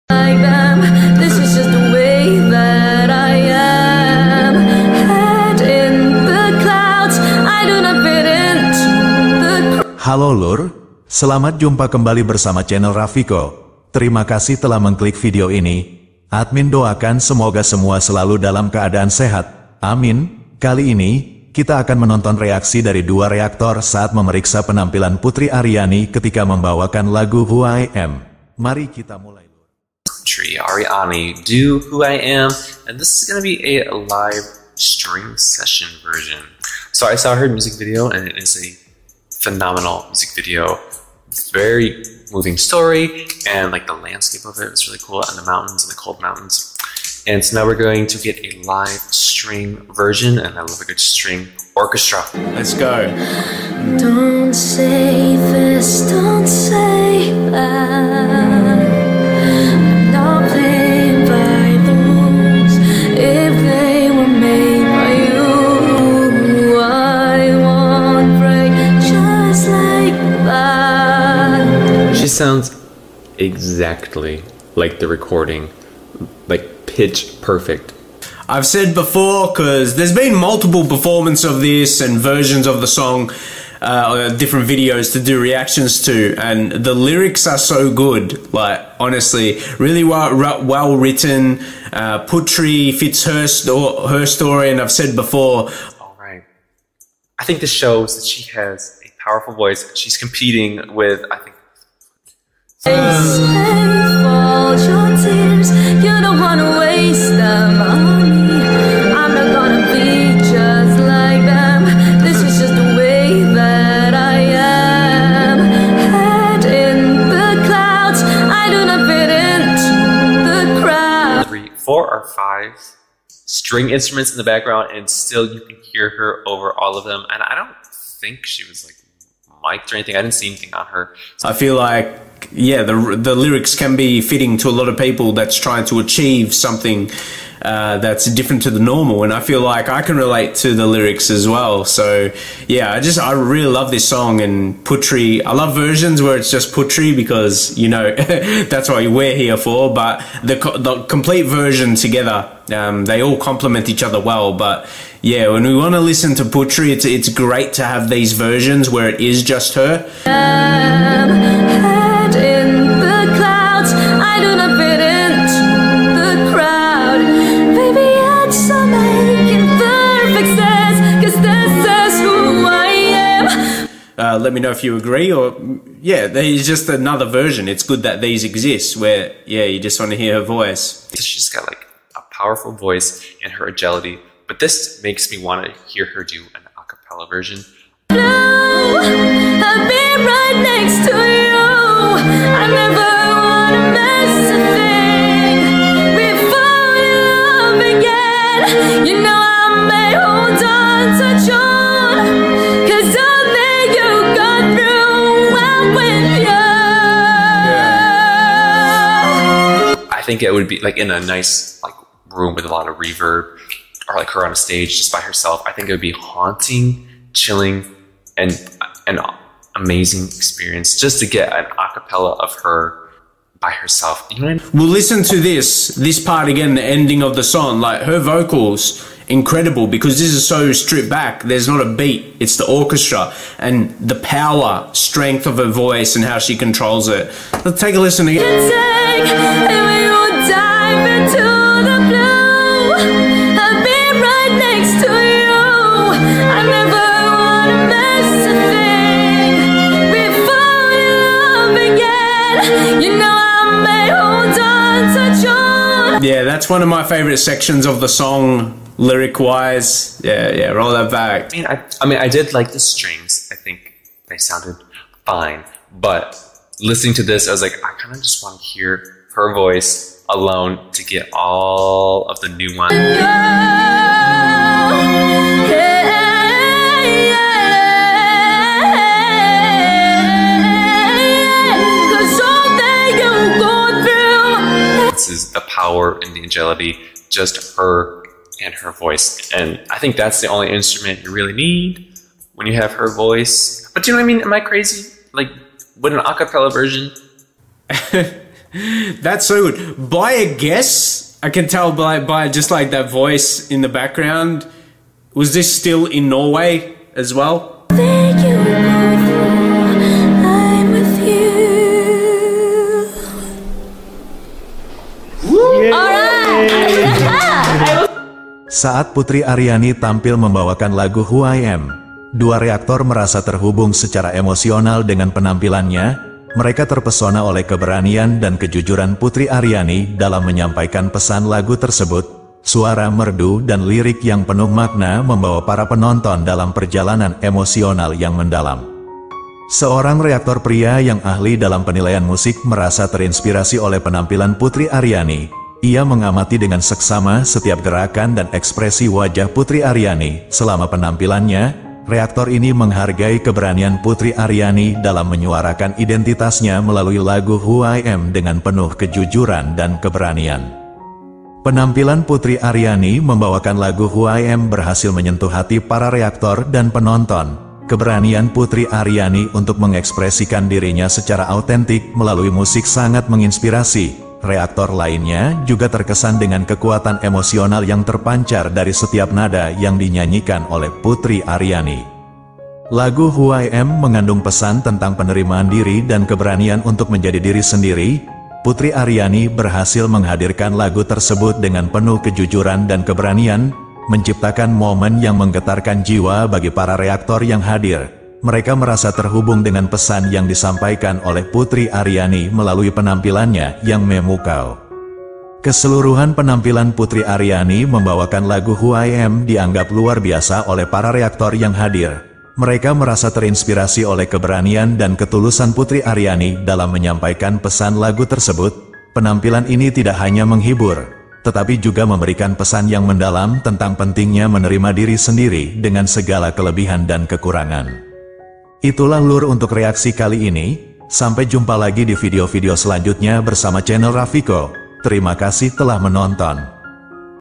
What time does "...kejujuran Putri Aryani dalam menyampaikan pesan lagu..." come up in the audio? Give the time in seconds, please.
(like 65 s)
328 s.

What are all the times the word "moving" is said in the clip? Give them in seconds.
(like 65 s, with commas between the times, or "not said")
42 s.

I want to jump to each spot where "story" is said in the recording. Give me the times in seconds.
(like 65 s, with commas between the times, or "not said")
42 s, 94 s.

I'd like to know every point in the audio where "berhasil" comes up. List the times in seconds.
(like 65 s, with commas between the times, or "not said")
364 s, 389 s.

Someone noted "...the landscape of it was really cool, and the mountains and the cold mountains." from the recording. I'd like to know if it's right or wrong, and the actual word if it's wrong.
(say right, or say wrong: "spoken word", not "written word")
right.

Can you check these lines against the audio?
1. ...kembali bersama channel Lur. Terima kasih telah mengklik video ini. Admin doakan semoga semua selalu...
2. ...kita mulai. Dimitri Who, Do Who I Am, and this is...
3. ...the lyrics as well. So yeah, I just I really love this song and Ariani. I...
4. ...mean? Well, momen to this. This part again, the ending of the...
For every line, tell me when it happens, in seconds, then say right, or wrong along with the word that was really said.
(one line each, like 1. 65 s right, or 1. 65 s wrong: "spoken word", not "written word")
1. 11 s wrong: "Rafiko", not "Lur"
2. 28 s wrong: "Ariani", not "Who"
3. 140 s wrong: "Putri", not "Ariani"
4. 224 s wrong: "listen", not "momen".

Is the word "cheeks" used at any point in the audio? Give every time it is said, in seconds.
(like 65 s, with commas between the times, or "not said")
not said.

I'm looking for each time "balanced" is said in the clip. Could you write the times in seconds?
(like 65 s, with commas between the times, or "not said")
not said.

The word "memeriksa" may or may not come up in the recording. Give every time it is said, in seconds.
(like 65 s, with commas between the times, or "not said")
24 s.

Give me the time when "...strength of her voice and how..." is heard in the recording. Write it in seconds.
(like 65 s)
234 s.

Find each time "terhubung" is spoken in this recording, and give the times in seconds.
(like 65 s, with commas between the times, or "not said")
323 s, 399 s.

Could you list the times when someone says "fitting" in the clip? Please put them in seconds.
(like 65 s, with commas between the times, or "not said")
134 s.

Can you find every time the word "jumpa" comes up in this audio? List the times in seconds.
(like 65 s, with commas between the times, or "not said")
11 s, 431 s.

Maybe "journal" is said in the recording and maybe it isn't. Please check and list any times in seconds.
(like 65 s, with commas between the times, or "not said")
not said.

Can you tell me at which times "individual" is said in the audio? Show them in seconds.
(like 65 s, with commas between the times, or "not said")
not said.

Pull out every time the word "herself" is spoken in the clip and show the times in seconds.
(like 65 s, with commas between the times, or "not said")
215 s, 223 s.